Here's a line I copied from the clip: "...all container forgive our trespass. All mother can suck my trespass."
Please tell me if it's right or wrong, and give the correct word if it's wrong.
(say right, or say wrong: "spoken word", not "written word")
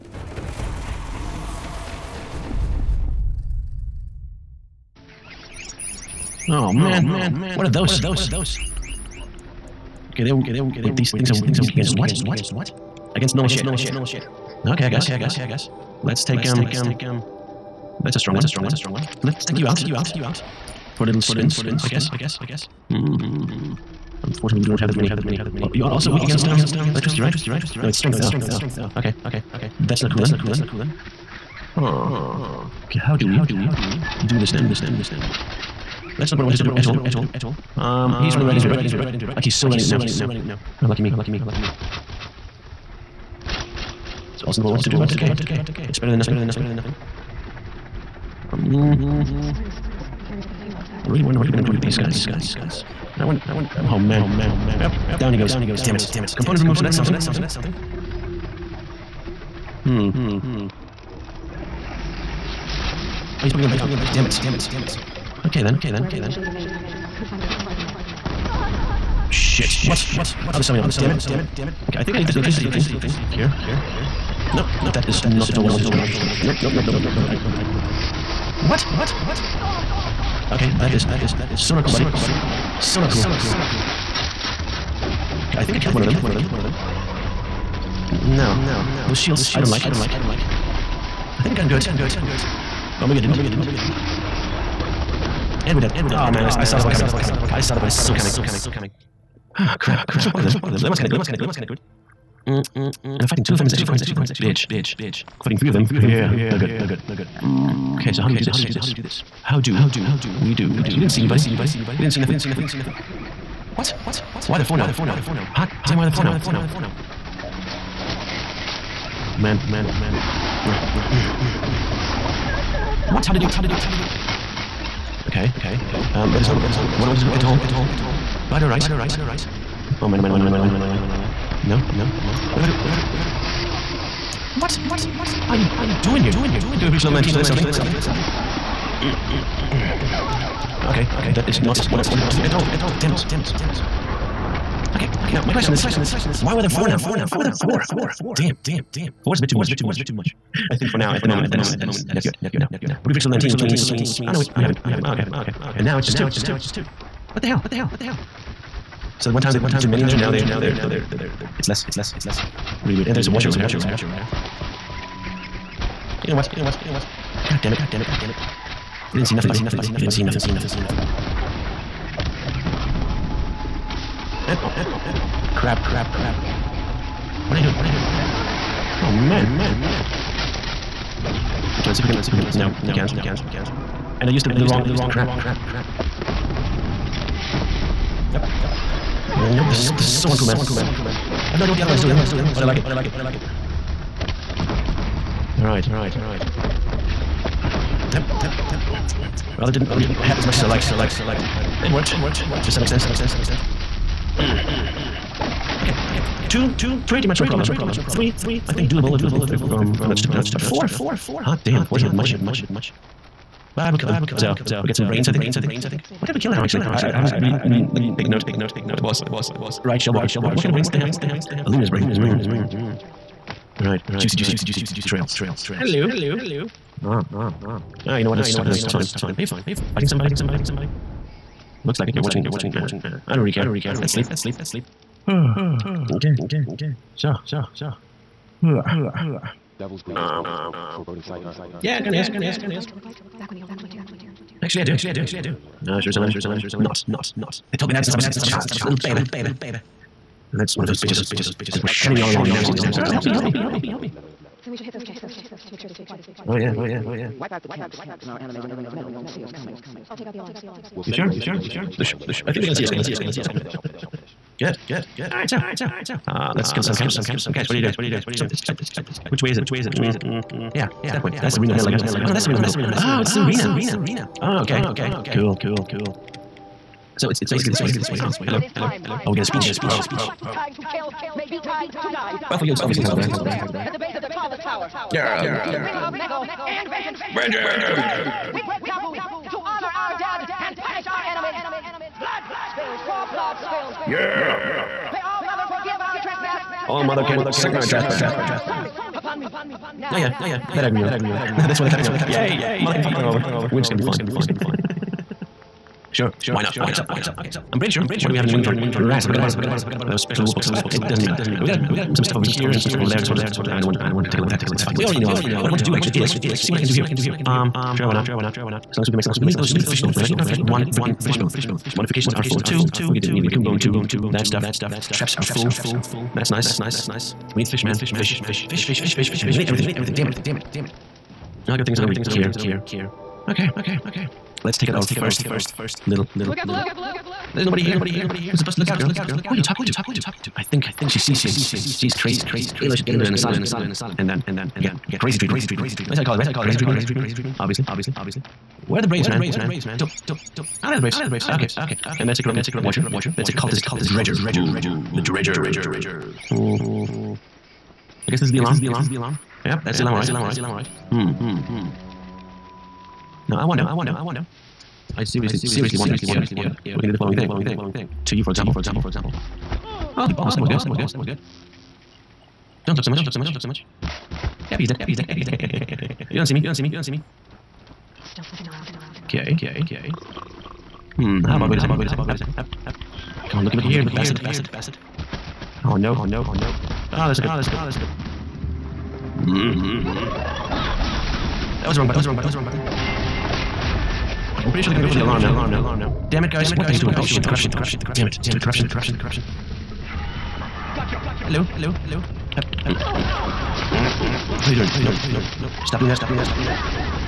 wrong: "mother", not "container".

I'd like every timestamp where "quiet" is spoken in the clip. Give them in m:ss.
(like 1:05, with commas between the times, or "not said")
4:16.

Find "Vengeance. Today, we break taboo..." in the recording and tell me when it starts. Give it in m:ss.
4:47.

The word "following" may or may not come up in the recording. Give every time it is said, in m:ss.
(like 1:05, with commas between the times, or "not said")
6:07.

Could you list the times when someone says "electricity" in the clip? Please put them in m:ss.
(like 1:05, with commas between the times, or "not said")
0:26, 1:12.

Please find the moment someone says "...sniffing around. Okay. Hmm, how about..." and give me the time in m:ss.
6:18.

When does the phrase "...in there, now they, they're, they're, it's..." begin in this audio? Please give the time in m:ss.
2:40.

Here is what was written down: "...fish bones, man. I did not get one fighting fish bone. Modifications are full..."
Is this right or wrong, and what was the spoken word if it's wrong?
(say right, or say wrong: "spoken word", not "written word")
wrong: "freaking", not "fighting".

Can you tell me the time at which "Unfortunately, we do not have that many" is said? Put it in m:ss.
0:24.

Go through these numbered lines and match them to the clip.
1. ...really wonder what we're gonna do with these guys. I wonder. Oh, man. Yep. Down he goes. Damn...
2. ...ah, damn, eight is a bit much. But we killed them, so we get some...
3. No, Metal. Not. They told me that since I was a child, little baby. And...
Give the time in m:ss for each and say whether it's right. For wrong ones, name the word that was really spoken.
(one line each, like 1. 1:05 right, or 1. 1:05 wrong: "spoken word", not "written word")
1. 0:51 right
2. 3:31 wrong: "four", not "eight"
3. 4:05 wrong: "Jerusalem", not "Metal".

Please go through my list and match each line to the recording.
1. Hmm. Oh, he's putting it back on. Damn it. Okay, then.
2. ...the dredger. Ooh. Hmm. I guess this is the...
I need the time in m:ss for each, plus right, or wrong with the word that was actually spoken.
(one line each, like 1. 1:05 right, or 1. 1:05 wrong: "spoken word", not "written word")
1. 0:59 right
2. 5:55 right.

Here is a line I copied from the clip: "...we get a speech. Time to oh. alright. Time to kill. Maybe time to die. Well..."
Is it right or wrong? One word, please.
wrong.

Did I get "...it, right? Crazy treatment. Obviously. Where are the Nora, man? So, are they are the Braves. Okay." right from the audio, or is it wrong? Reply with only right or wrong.
wrong.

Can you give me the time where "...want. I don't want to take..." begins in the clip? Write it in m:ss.
5:13.